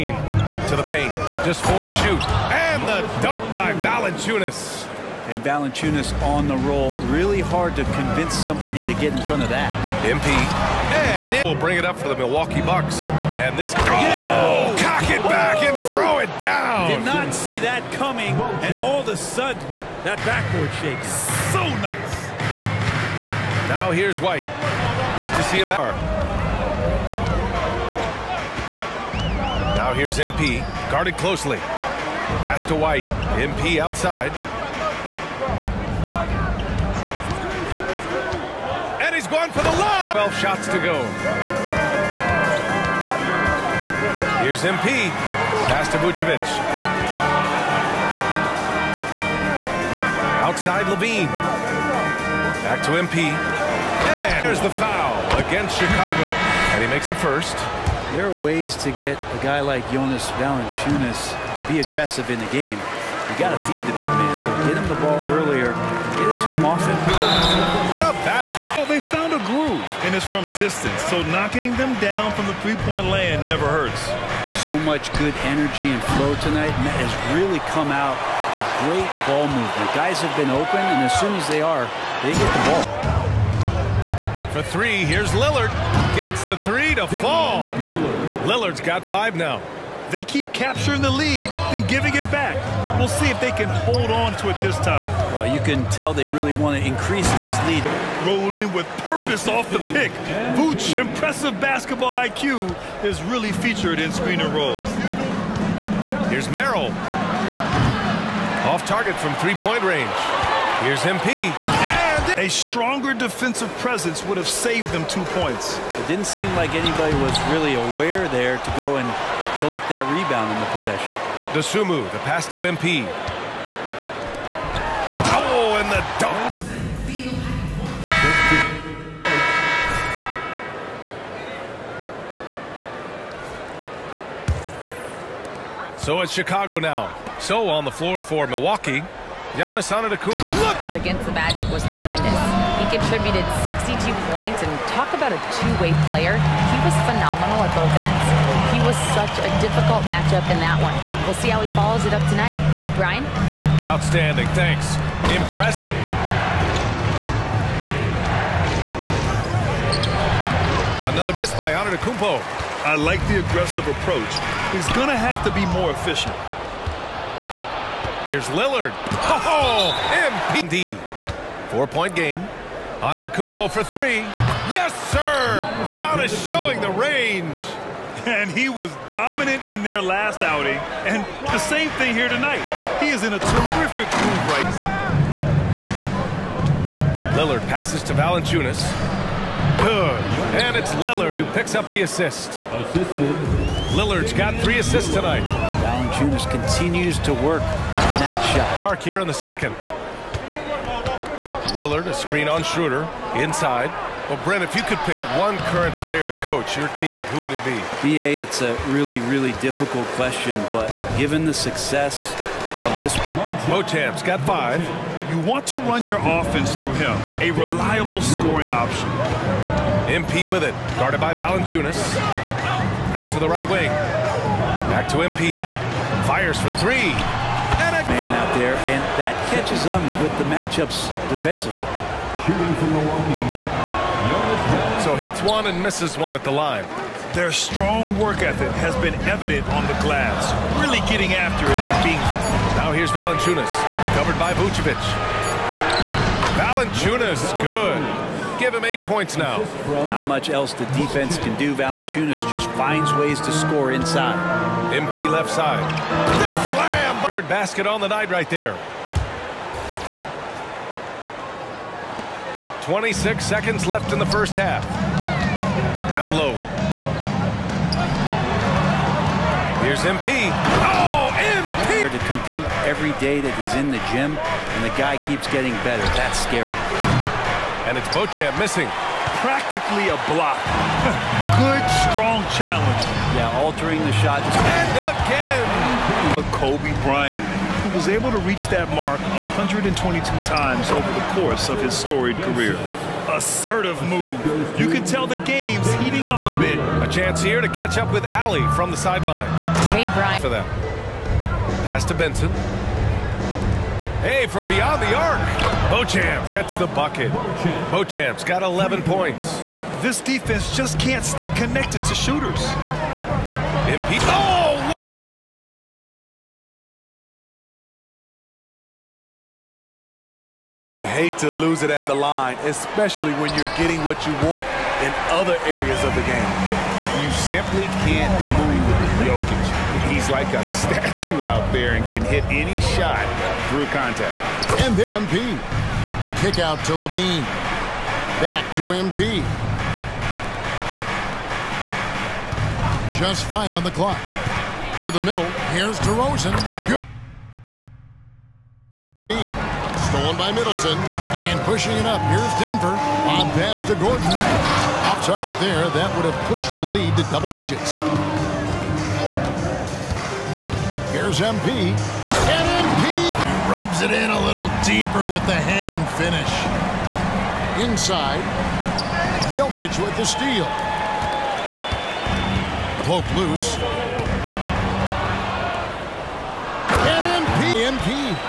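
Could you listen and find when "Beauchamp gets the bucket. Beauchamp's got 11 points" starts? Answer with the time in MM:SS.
05:05.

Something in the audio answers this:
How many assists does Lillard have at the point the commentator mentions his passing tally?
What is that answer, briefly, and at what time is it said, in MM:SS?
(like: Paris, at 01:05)
3, at 03:14.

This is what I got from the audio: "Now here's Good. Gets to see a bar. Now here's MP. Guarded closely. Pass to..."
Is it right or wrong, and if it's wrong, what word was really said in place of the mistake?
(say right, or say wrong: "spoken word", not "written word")
wrong: "White", not "Good".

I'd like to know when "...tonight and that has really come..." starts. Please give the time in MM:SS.
01:16.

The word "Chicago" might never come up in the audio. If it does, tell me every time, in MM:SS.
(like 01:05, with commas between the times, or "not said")
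00:55, 02:16.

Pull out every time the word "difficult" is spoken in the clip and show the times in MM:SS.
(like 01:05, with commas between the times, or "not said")
02:29, 03:29.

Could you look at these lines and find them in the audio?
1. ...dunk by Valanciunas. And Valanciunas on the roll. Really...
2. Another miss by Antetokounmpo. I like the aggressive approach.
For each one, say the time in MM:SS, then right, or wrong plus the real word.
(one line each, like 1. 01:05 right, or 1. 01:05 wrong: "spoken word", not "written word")
1. 00:03 right
2. 02:41 right.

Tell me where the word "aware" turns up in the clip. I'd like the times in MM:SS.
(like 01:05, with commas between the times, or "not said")
01:57.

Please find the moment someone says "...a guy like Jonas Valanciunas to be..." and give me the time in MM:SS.
00:59.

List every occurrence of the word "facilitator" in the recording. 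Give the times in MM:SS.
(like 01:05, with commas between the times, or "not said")
not said.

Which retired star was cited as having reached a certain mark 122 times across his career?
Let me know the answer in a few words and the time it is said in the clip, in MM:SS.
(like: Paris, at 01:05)
Kobe Bryant, at 04:46.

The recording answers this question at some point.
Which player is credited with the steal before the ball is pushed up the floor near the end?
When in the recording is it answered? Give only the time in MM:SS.
05:50.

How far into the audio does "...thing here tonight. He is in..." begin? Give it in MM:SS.
03:01.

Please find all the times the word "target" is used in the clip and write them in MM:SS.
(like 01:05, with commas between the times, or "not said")
01:48, 05:55.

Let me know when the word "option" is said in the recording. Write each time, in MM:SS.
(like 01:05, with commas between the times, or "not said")
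03:38.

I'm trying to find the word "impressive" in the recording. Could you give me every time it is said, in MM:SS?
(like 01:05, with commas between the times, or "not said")
01:40, 02:35.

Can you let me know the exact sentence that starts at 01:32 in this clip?
We'll see if they can hold on to it this time.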